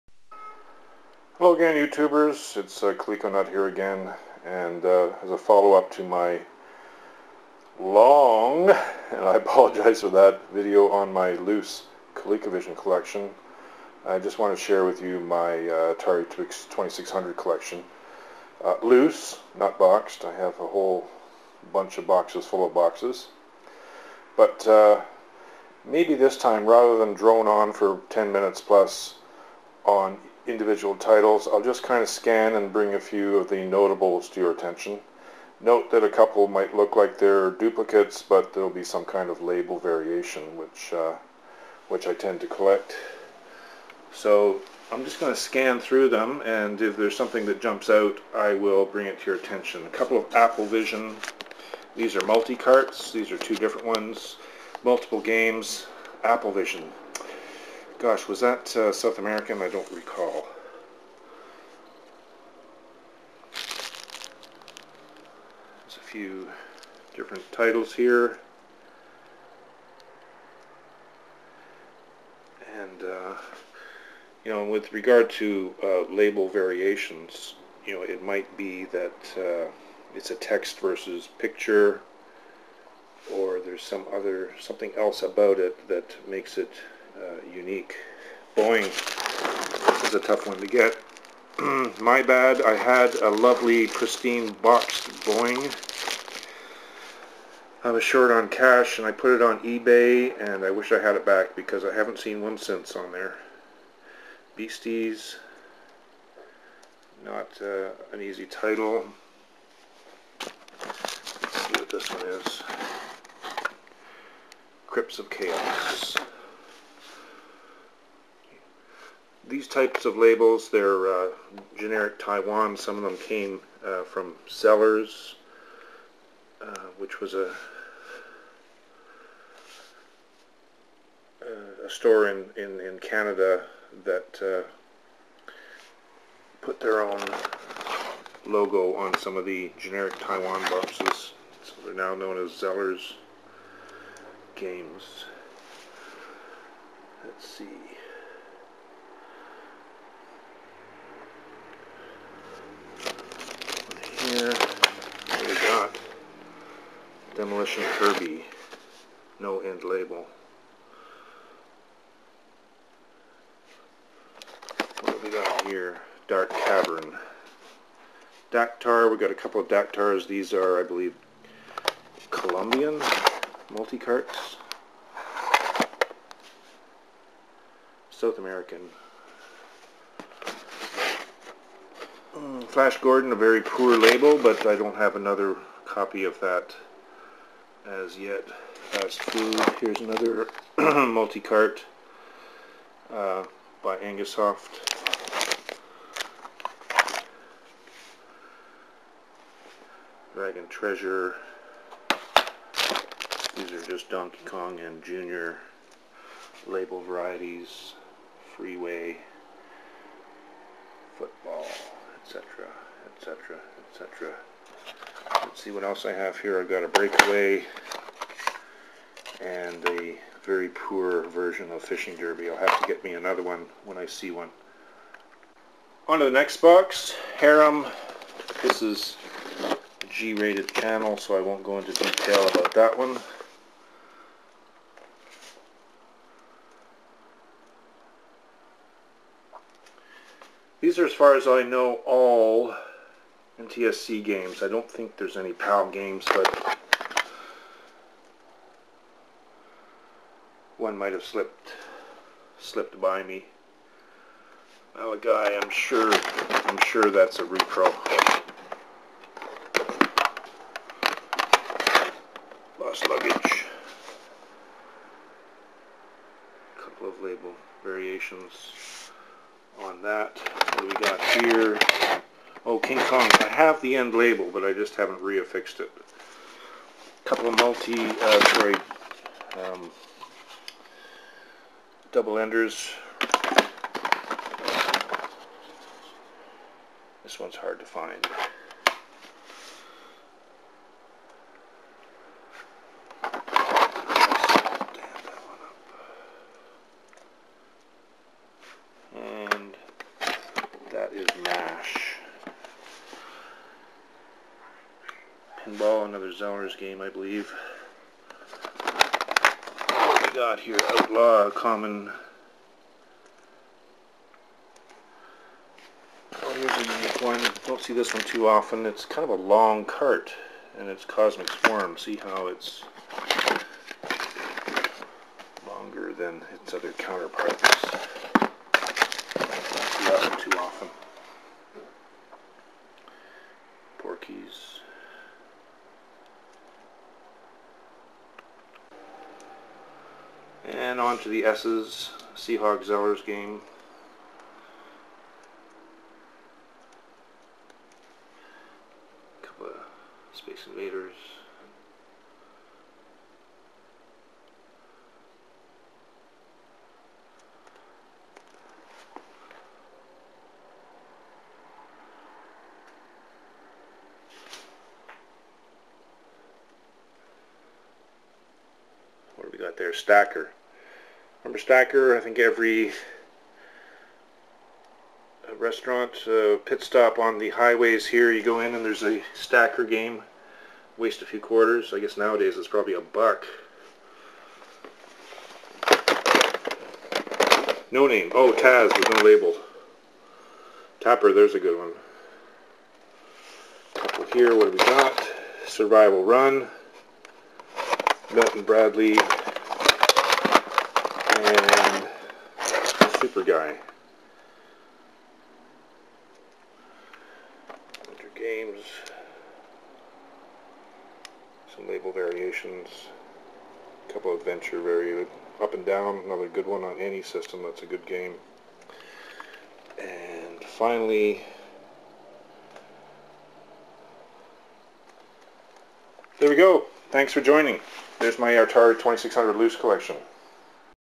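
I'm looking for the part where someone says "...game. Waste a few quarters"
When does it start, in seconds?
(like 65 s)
379 s.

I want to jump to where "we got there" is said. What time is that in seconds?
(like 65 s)
369 s.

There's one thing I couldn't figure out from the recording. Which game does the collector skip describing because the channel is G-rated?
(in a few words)
Harem.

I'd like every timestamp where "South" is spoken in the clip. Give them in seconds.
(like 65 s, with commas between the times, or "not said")
58 s, 178 s.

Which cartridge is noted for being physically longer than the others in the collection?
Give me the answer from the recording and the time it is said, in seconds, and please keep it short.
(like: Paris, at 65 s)
Cosmic Swarm, at 321 s.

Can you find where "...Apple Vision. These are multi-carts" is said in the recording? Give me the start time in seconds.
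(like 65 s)
50 s.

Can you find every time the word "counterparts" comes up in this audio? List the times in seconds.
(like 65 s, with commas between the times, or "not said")
326 s.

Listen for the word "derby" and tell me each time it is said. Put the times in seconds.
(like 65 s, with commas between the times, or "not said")
222 s.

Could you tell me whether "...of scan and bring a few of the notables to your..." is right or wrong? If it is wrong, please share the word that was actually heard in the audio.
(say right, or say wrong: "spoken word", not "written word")
right.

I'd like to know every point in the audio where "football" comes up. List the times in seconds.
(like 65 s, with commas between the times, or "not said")
211 s.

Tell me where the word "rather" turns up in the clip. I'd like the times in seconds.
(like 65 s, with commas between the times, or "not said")
26 s.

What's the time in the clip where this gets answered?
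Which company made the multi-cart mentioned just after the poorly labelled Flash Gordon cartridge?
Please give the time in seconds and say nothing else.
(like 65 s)
193 s.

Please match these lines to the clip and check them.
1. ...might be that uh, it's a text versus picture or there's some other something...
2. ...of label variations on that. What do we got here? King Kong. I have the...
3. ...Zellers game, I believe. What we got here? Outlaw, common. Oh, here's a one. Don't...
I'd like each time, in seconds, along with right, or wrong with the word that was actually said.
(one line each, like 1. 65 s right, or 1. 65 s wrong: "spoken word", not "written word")
1. 78 s right
2. 267 s right
3. 306 s right.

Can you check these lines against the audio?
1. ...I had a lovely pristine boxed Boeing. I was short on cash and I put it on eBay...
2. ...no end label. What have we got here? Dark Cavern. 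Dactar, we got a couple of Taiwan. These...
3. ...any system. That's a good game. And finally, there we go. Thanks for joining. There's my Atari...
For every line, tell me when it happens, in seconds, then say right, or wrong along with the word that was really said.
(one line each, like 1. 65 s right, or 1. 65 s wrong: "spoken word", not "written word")
1. 92 s right
2. 159 s wrong: "Dactars", not "Taiwan"
3. 416 s right.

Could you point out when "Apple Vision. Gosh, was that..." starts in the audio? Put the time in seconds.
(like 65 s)
56 s.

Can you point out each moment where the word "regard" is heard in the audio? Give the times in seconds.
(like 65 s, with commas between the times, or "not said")
74 s.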